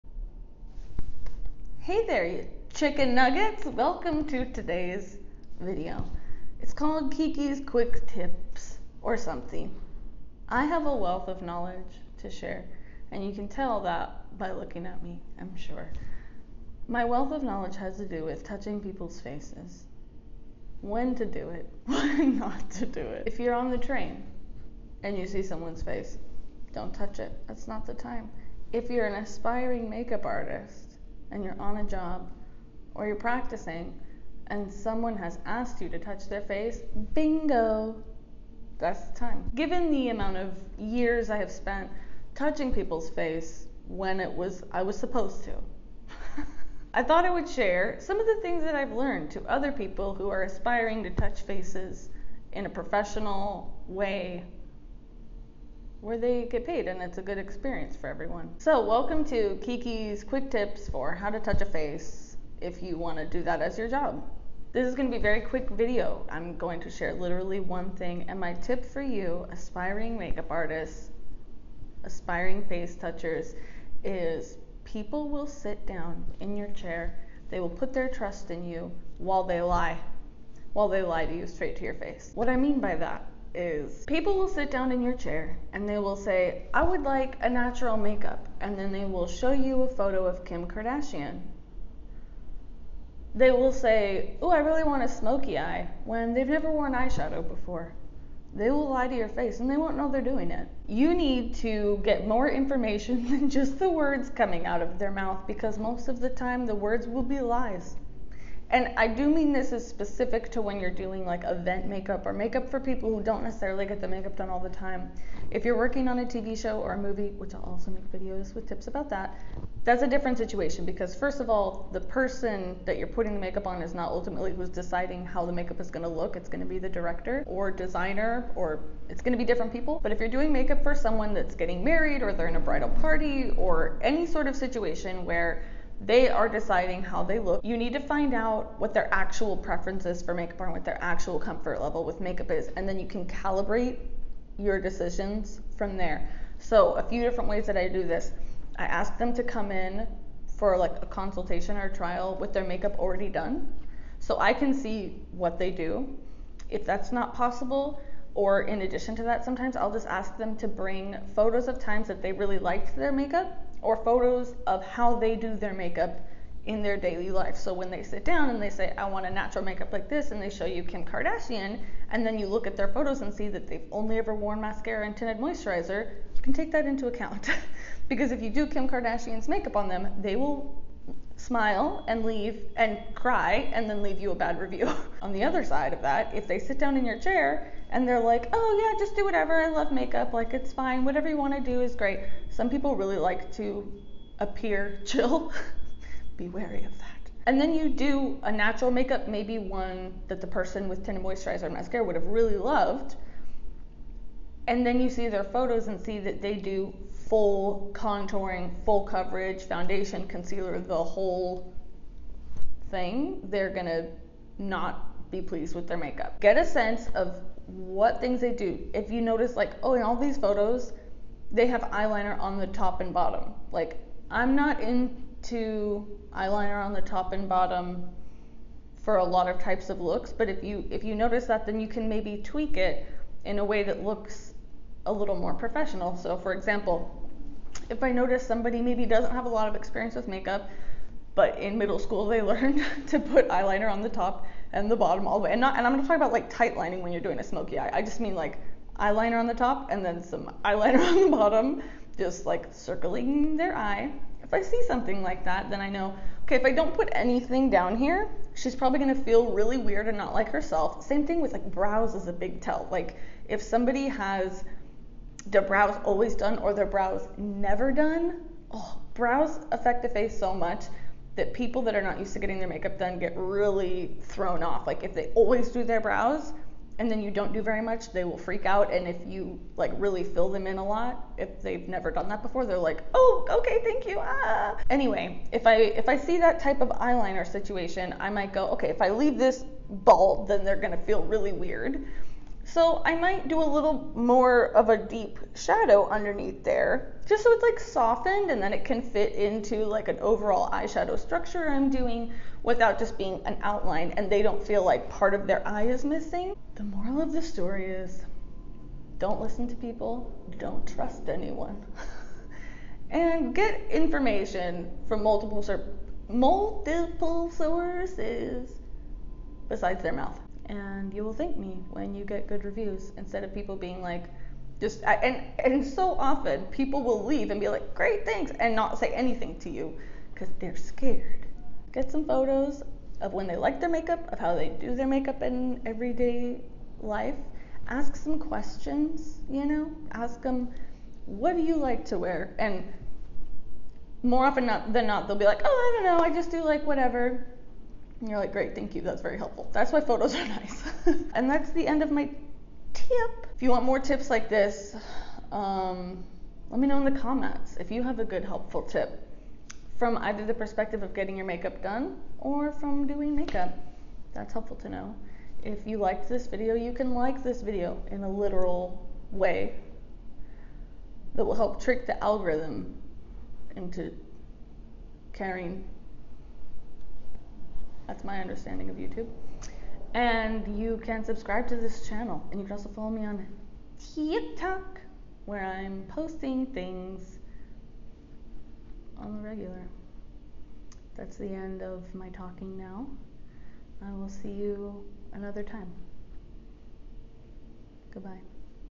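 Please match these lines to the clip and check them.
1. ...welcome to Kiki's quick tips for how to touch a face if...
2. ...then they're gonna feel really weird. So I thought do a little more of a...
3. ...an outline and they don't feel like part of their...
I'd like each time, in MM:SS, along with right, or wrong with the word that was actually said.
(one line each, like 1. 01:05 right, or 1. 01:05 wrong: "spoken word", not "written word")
1. 00:58 right
2. 04:50 wrong: "might", not "thought"
3. 05:03 right.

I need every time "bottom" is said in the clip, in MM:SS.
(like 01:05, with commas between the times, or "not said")
03:43, 03:47, 04:04, 04:11.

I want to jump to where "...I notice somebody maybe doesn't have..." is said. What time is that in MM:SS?
03:58.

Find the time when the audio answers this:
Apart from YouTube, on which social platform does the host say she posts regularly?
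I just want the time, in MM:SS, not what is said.
06:24.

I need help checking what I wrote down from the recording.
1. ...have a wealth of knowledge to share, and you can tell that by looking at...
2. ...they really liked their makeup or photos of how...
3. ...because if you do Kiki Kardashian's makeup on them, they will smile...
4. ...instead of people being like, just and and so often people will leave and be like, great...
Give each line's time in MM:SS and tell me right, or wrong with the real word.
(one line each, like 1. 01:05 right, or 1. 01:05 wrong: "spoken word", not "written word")
1. 00:10 right
2. 02:42 right
3. 02:58 wrong: "Kim", not "Kiki"
4. 05:23 right.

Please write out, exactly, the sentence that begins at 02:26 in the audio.
So, a few different ways that I do this.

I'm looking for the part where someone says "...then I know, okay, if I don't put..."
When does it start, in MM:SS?
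04:15.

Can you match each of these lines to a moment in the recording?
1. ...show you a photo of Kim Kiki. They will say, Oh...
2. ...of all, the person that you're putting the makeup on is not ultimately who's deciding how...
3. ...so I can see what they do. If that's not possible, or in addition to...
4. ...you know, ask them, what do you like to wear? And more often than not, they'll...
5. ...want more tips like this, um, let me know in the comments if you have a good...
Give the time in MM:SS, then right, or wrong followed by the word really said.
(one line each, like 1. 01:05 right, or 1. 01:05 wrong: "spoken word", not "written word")
1. 01:29 wrong: "Kardashian", not "Kiki"
2. 02:01 right
3. 02:34 right
4. 05:39 right
5. 05:53 right.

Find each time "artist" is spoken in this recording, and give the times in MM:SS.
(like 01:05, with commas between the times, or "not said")
00:30, 01:10.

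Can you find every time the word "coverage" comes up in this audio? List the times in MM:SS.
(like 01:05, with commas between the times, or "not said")
03:29.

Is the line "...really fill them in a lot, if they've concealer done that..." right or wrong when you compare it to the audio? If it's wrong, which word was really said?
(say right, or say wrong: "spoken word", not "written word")
wrong: "never", not "concealer".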